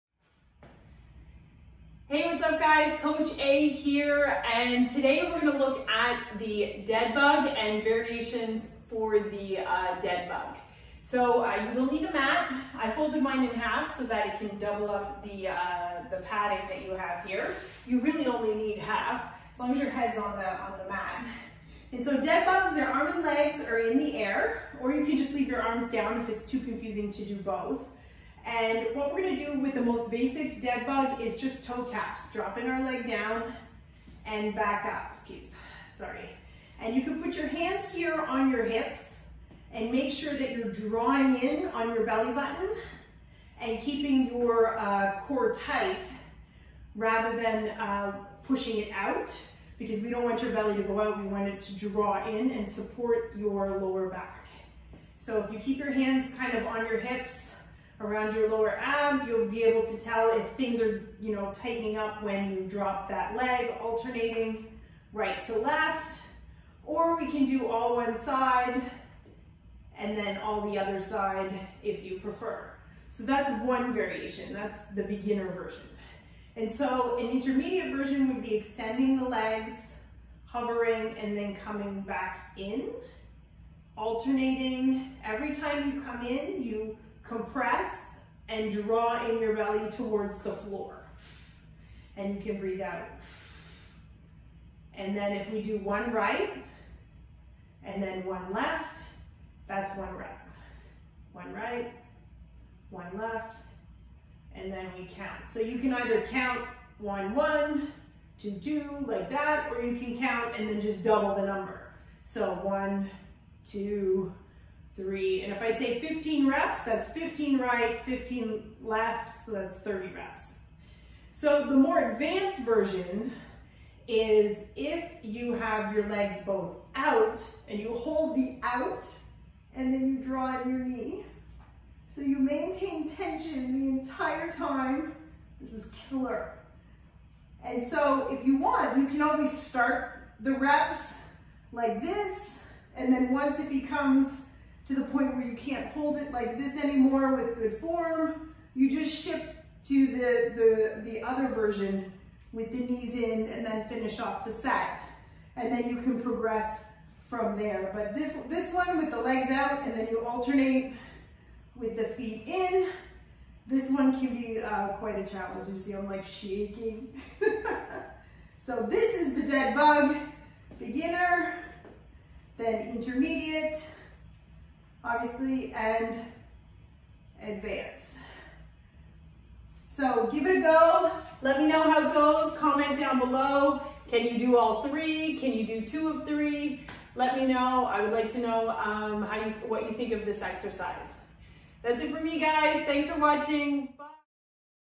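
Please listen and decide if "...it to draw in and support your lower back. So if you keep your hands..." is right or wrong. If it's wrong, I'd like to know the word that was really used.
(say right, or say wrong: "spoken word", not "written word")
right.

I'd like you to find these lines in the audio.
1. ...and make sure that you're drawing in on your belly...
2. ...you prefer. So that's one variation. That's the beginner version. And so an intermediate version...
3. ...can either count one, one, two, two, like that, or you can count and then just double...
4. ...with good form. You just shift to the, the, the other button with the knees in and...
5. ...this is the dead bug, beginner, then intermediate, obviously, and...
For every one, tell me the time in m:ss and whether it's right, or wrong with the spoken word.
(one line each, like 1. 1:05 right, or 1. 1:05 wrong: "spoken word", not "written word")
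1. 0:39 right
2. 1:12 right
3. 1:45 right
4. 2:27 wrong: "version", not "button"
5. 2:48 right.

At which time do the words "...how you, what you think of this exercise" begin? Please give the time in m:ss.
3:09.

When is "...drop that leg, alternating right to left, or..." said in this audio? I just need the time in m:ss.
1:02.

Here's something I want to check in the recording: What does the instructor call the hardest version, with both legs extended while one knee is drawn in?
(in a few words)
Advanced version.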